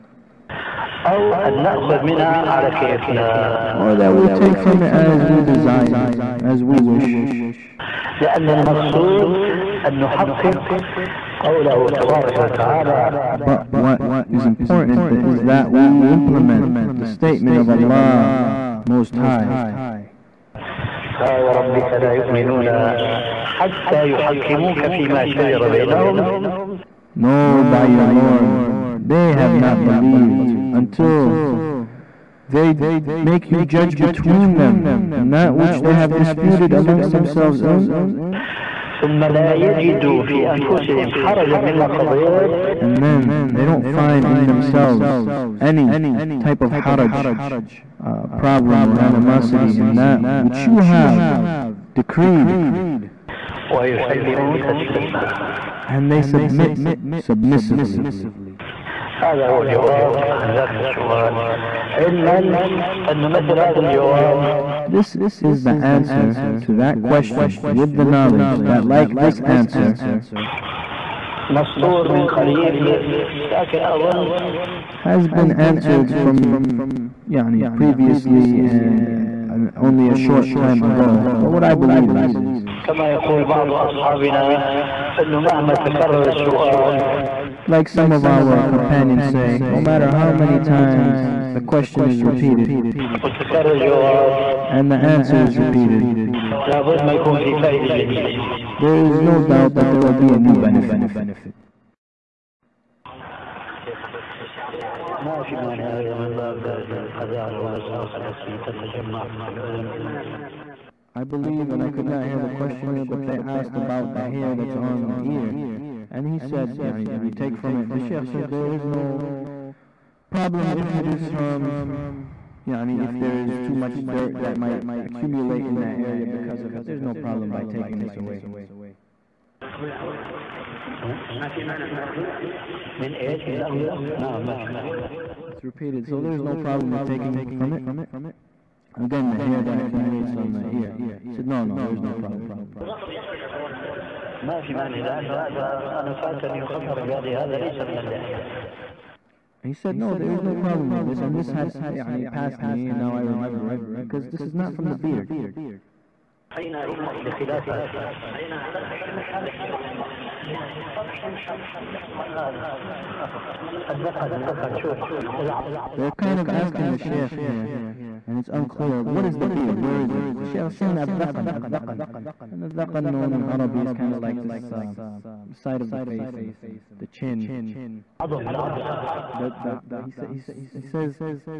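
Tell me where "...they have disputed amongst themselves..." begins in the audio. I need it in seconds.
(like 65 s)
35 s.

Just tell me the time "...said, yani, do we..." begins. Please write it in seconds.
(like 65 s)
116 s.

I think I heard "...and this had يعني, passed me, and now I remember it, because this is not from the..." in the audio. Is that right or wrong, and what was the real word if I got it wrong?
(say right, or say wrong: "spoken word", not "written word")
right.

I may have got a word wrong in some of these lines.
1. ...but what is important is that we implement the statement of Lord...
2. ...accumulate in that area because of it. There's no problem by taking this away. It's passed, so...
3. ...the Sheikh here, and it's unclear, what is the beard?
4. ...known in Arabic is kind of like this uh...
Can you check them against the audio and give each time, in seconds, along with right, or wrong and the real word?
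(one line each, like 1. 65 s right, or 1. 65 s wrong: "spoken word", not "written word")
1. 13 s wrong: "Allah", not "Lord"
2. 125 s wrong: "repeated", not "passed"
3. 166 s right
4. 173 s right.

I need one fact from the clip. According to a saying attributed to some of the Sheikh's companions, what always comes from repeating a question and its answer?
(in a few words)
a new benefit.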